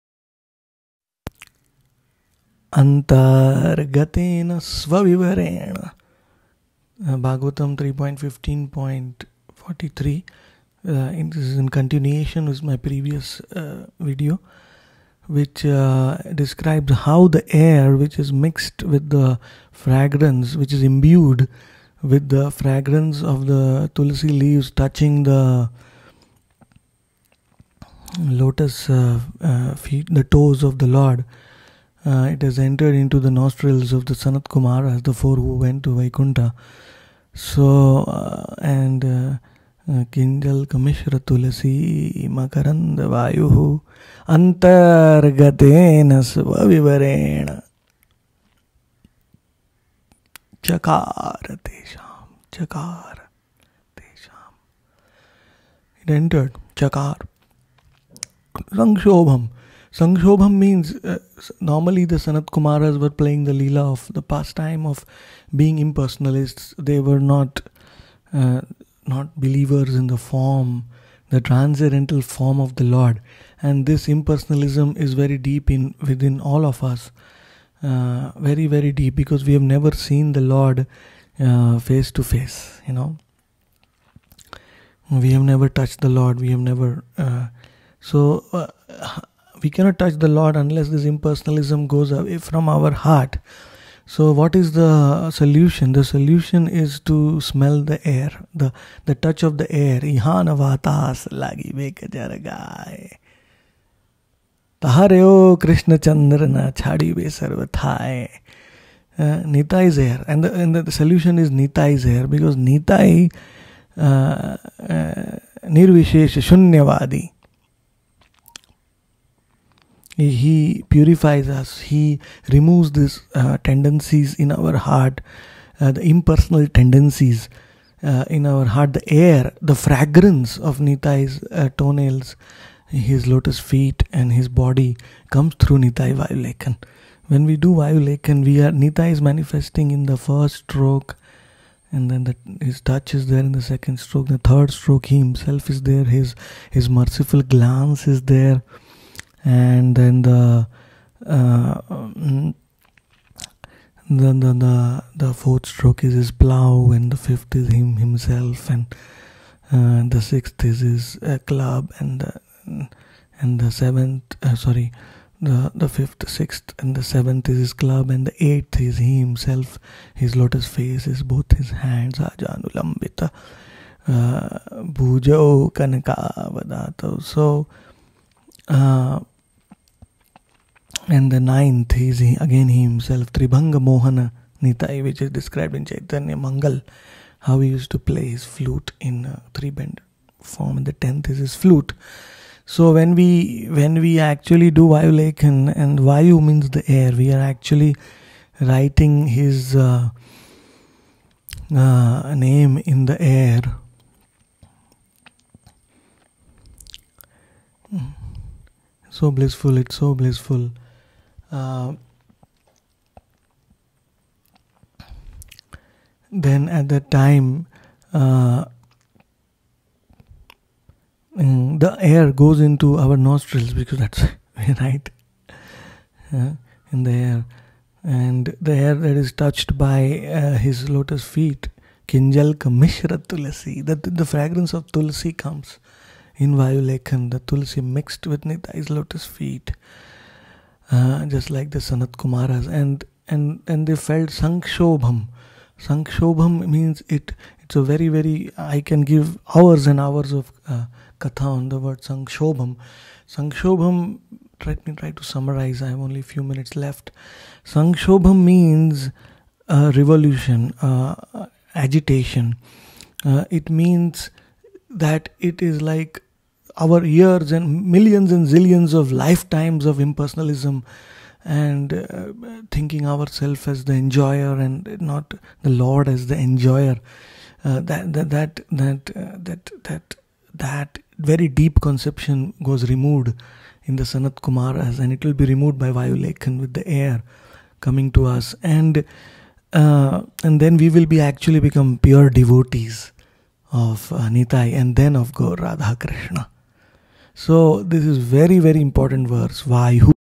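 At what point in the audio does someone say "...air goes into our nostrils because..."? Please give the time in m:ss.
3:41.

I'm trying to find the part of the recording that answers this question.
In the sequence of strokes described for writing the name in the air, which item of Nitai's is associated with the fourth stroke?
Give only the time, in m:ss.
2:36.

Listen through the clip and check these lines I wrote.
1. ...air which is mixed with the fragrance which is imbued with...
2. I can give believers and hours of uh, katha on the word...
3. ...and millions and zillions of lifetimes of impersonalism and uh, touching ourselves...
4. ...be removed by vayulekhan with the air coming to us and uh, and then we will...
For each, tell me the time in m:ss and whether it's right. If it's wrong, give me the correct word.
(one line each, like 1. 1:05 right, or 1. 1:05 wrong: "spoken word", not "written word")
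1. 0:17 right
2. 4:08 wrong: "hours", not "believers"
3. 4:27 wrong: "thinking", not "touching"
4. 4:45 right.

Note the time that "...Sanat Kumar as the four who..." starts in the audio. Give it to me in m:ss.
0:34.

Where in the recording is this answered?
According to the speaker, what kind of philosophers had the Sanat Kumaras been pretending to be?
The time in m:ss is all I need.
1:05.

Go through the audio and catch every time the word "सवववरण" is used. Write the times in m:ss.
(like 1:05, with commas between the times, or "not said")
0:04, 0:46.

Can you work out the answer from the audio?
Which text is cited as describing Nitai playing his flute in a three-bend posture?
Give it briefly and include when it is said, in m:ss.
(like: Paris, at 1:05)
Chaitanya Mangal, at 3:05.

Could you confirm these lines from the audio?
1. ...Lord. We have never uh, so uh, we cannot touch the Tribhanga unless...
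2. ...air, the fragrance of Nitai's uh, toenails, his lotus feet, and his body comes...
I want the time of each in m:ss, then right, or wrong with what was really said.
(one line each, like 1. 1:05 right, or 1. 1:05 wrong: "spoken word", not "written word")
1. 1:26 wrong: "Lord", not "Tribhanga"
2. 2:09 right.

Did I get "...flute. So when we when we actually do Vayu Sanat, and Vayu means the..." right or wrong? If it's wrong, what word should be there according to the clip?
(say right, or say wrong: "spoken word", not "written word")
wrong: "Lekhan", not "Sanat".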